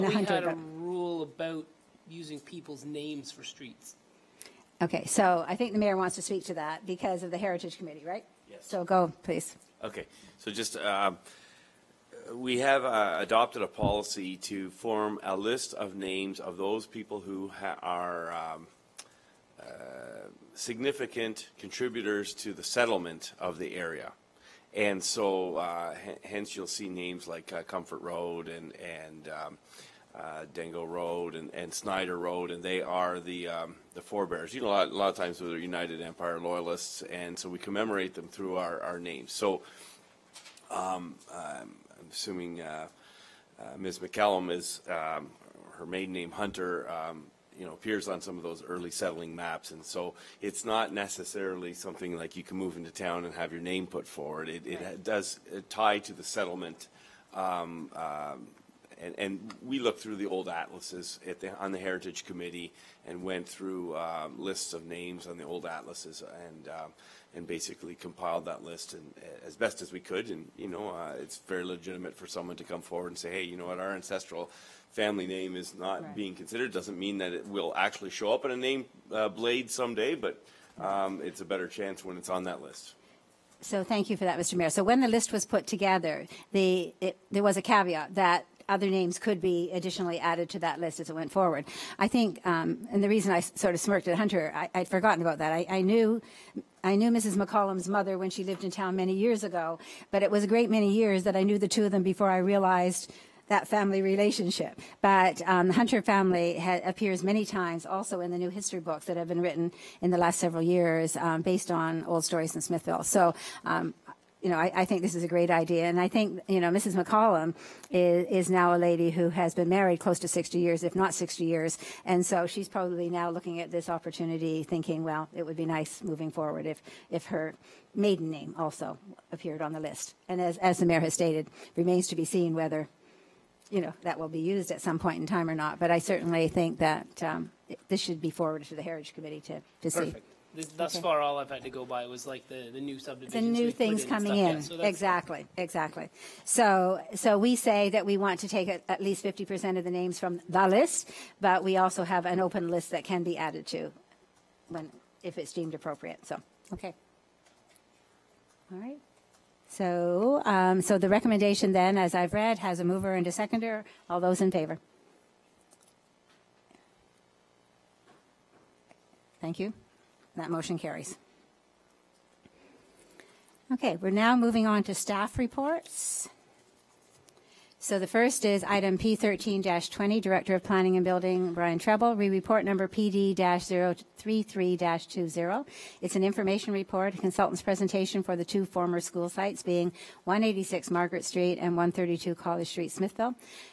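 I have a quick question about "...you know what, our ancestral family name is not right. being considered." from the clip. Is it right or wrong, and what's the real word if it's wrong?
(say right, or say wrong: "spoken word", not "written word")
right.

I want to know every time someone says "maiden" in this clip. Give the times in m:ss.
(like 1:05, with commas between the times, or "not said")
0:45, 2:07.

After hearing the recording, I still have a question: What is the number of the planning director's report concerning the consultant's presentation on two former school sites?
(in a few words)
PD-033-20.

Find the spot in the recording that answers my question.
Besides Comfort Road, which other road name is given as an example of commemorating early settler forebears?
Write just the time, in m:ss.
0:31.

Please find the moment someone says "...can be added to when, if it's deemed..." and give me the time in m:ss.
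2:33.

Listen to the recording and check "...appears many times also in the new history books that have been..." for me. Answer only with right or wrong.
right.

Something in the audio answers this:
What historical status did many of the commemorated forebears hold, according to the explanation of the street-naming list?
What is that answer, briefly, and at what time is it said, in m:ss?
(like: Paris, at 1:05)
United Empire loyalists, at 0:35.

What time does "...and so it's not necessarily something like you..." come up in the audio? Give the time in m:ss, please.
0:49.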